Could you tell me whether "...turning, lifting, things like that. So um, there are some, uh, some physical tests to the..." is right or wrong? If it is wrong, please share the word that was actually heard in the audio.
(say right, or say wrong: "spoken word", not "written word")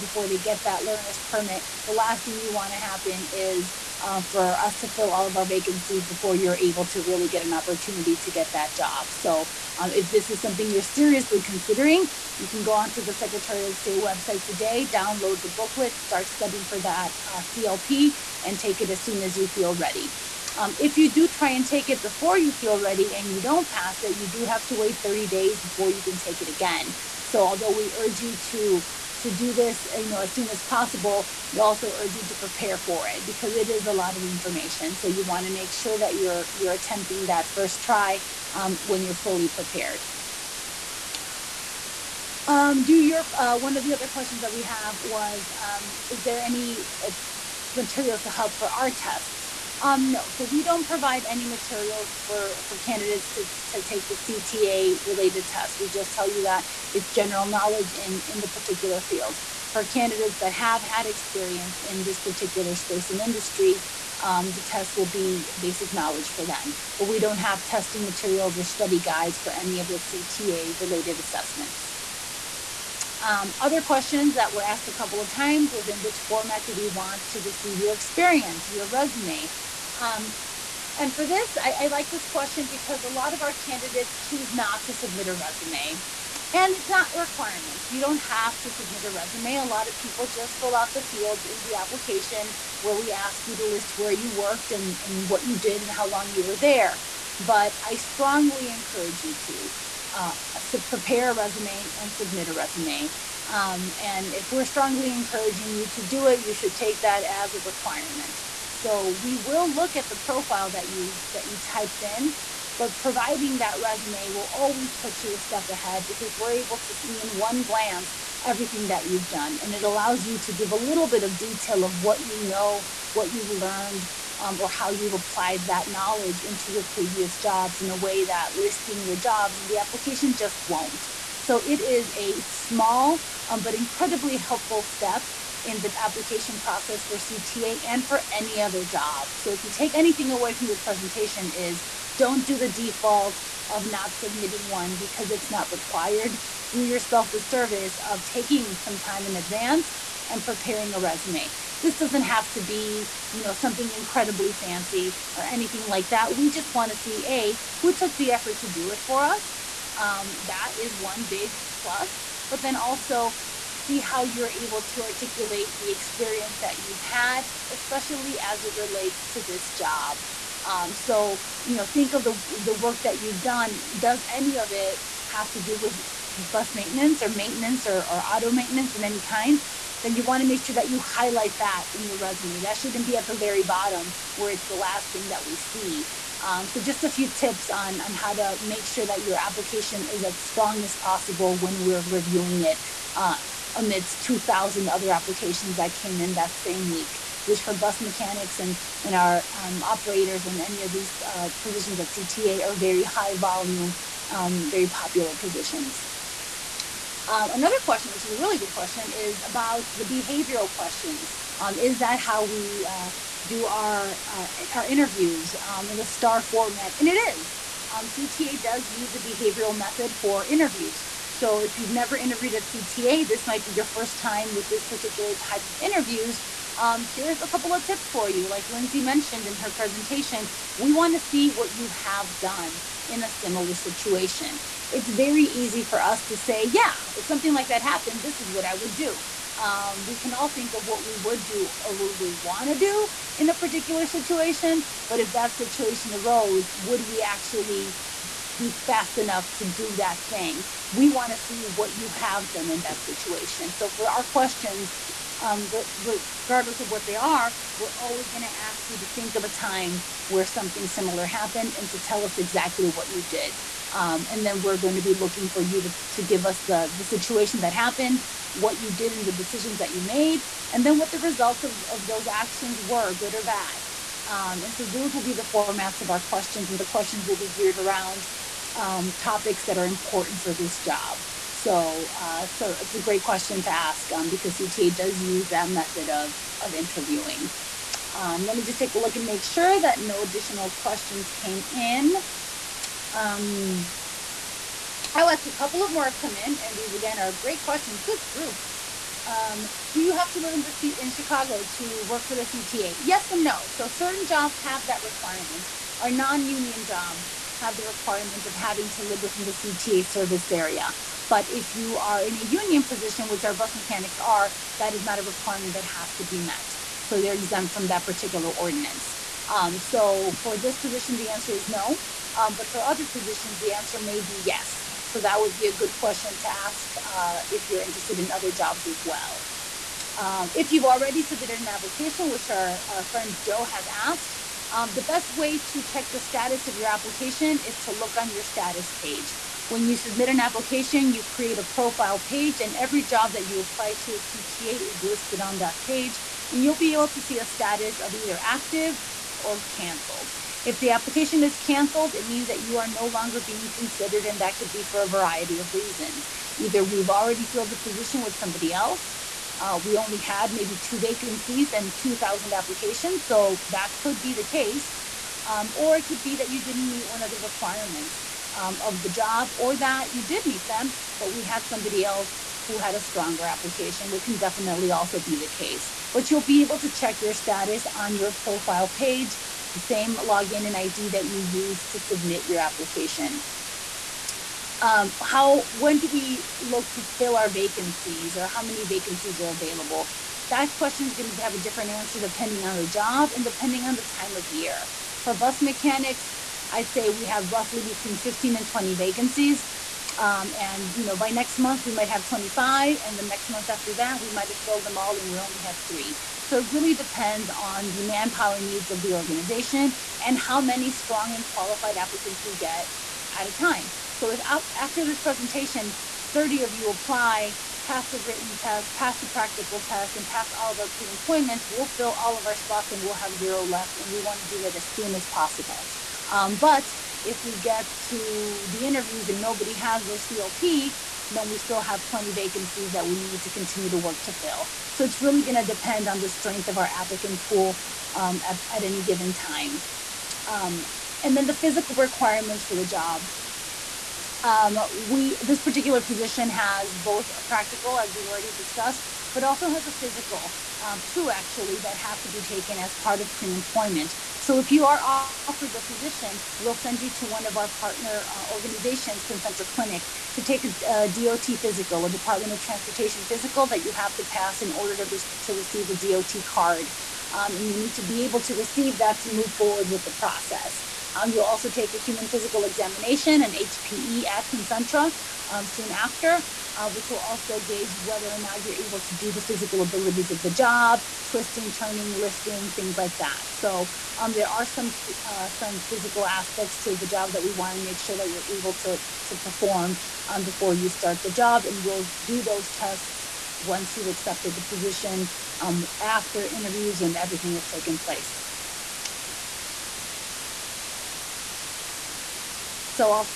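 wrong: "aspects", not "tests".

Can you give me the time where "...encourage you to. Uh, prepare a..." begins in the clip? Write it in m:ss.
1:38.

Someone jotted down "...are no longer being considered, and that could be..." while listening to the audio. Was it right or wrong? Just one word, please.
right.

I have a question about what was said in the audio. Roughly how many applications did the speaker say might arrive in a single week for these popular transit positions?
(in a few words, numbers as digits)
2,000.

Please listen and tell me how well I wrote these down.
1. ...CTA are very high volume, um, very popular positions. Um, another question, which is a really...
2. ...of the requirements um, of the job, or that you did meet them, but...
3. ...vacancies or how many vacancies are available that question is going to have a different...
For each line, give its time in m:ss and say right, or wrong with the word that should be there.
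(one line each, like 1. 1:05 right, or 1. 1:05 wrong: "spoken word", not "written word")
1. 3:22 right
2. 6:07 right
3. 6:27 right.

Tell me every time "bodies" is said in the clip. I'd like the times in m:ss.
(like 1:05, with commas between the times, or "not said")
not said.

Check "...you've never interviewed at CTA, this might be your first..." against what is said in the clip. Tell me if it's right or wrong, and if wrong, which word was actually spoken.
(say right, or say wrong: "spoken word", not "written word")
right.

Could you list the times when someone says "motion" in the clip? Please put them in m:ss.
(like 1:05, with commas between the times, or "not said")
not said.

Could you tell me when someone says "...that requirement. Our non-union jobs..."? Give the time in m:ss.
5:04.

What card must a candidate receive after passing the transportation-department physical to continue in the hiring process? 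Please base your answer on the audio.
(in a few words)
DOT card.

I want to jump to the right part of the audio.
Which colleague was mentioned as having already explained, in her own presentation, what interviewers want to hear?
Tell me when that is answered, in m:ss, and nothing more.
3:48.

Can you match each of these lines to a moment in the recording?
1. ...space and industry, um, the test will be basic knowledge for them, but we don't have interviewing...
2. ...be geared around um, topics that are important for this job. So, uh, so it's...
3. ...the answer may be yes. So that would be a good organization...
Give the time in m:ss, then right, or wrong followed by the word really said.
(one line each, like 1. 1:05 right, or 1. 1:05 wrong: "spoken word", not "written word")
1. 1:02 wrong: "testing", not "interviewing"
2. 4:37 right
3. 5:23 wrong: "question", not "organization".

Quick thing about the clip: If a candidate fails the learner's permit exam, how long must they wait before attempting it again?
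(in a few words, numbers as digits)
30 days.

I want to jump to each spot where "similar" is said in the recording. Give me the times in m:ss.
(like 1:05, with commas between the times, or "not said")
3:53, 4:20.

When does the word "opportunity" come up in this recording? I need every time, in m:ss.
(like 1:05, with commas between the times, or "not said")
0:07.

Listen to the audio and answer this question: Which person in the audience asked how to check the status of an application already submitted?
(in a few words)
Joe.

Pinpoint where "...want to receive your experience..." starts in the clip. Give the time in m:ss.
1:16.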